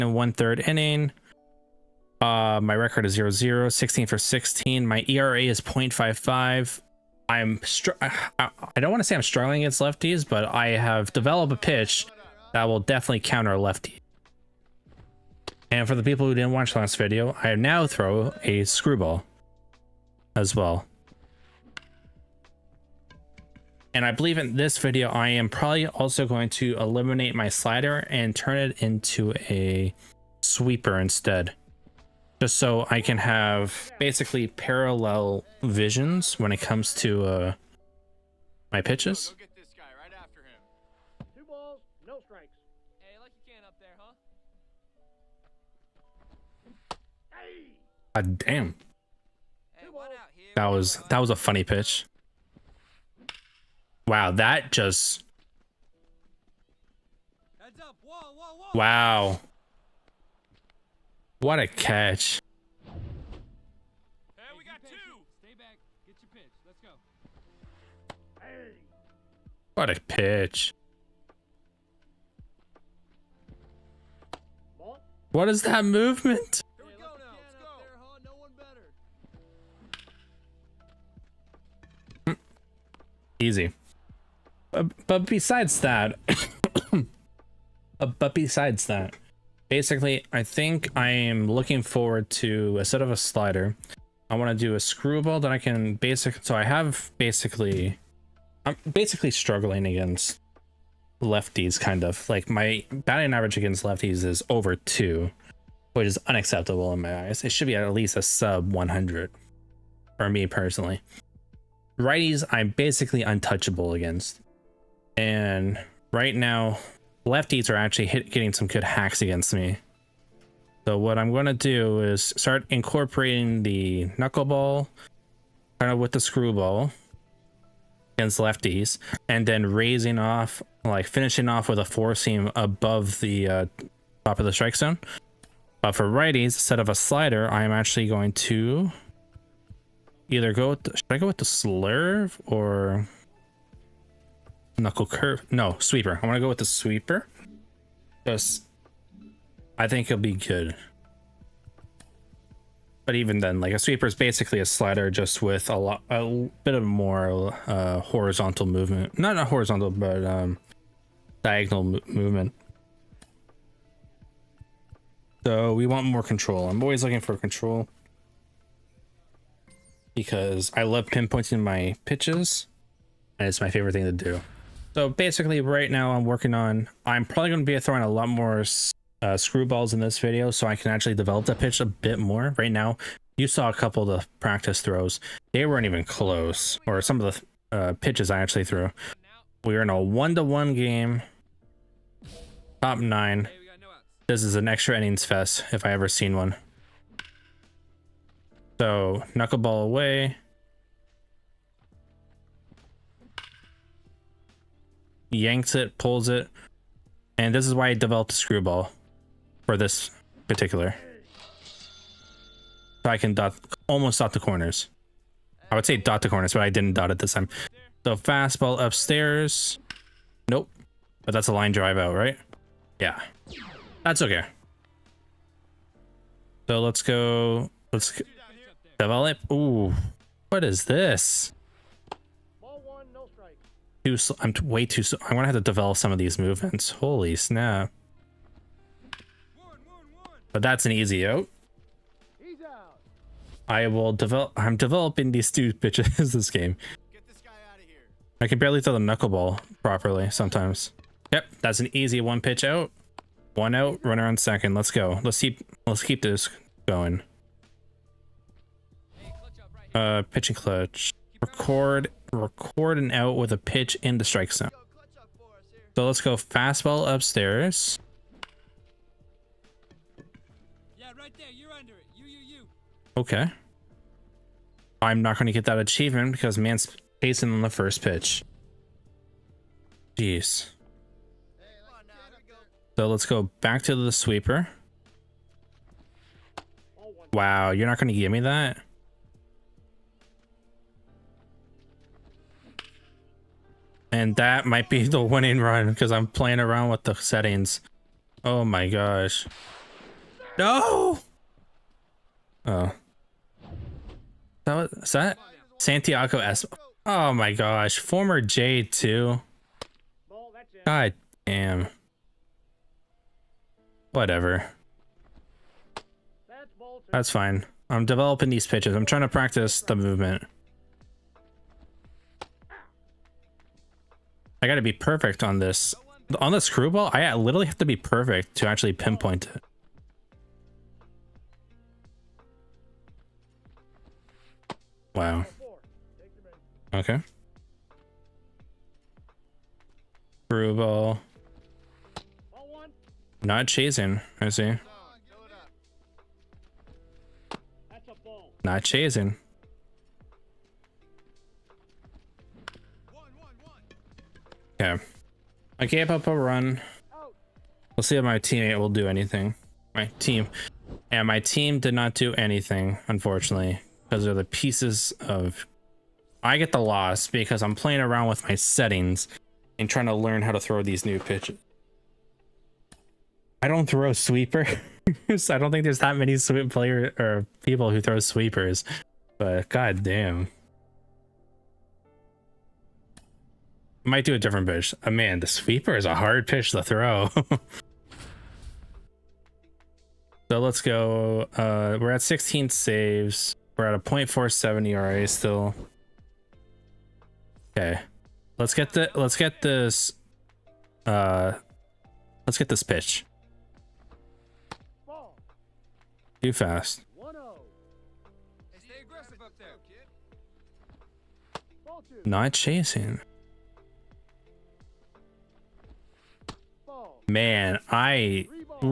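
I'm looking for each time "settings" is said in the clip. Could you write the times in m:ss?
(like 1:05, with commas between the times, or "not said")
4:57, 6:08.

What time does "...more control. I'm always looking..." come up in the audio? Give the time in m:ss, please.
2:46.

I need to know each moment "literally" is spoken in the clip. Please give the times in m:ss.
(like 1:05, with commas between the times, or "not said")
5:27.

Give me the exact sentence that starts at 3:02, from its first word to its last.
Right now, you saw a couple of the practice throws.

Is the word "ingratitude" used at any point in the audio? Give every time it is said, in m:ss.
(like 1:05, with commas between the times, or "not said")
not said.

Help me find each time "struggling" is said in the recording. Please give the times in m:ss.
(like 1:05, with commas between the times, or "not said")
0:09, 1:39.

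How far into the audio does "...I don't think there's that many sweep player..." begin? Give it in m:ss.
6:15.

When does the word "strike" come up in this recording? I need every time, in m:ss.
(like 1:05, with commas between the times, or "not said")
2:14, 4:24.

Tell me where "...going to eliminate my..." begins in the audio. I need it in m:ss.
0:26.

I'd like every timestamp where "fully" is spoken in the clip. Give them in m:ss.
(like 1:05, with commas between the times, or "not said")
not said.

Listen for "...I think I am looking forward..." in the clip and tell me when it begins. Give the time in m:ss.
1:30.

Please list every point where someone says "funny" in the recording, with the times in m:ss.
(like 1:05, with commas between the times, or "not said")
0:51.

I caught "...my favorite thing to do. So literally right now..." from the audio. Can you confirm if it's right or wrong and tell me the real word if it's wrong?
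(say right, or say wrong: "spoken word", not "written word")
wrong: "basically", not "literally".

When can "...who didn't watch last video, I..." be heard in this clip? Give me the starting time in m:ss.
0:16.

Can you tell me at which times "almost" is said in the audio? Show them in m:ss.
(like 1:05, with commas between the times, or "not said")
3:33.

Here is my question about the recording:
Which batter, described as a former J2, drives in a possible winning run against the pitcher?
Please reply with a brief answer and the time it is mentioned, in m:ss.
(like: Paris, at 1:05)
Santiago S, at 5:05.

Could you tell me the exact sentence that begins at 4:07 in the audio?
This I can barely throw the knuckleball properly sometimes.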